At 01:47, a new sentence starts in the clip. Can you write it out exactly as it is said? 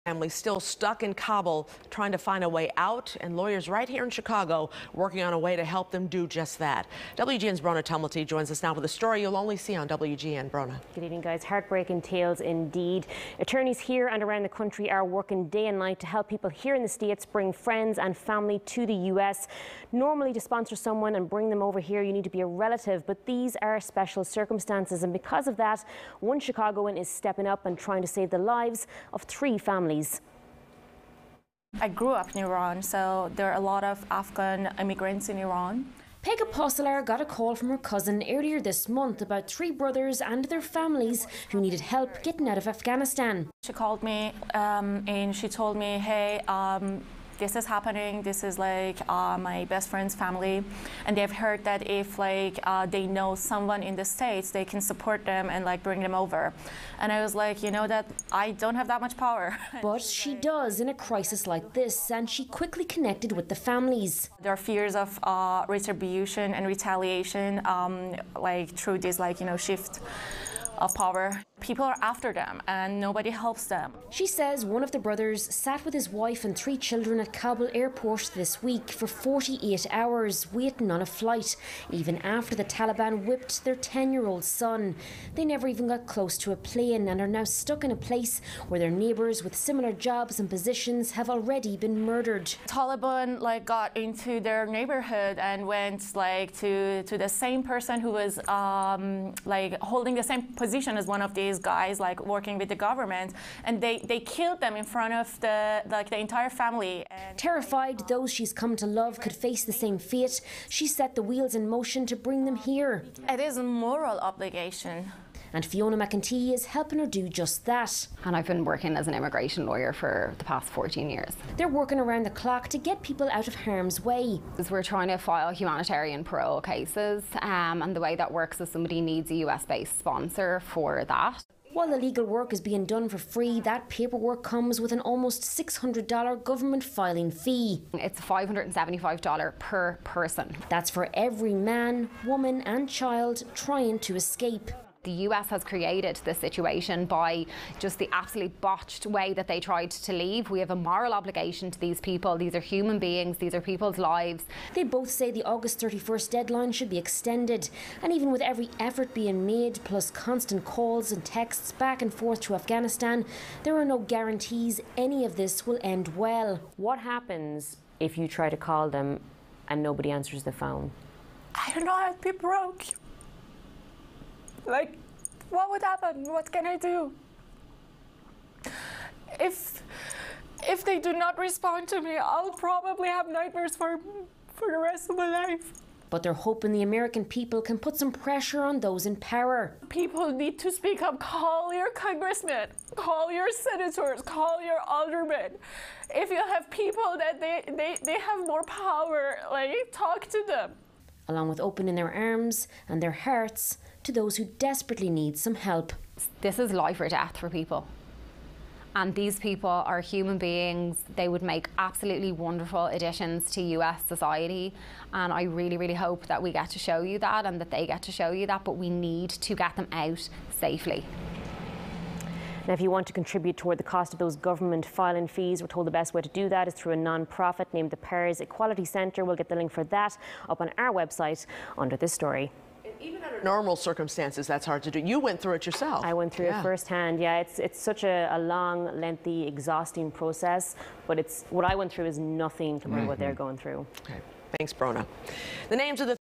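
And Terrified, those she's come to love could face the same fate.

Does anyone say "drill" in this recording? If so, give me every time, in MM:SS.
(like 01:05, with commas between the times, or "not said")
not said.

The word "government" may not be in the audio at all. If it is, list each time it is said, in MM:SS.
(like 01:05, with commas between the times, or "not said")
01:42, 02:16, 03:44.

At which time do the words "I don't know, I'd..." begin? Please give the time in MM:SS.
02:51.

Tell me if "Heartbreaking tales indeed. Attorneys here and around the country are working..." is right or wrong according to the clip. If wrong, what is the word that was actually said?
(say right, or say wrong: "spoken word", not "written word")
right.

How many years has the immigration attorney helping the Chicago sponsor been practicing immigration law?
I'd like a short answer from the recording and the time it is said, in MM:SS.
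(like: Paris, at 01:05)
14, at 02:00.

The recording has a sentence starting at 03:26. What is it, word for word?
This is life or death for people.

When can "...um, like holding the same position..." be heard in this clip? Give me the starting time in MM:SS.
01:38.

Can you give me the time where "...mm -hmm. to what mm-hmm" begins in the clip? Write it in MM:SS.
04:03.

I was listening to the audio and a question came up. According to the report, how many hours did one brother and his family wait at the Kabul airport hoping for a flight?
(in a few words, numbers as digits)
48.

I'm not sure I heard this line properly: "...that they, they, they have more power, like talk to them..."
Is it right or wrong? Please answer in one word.
right.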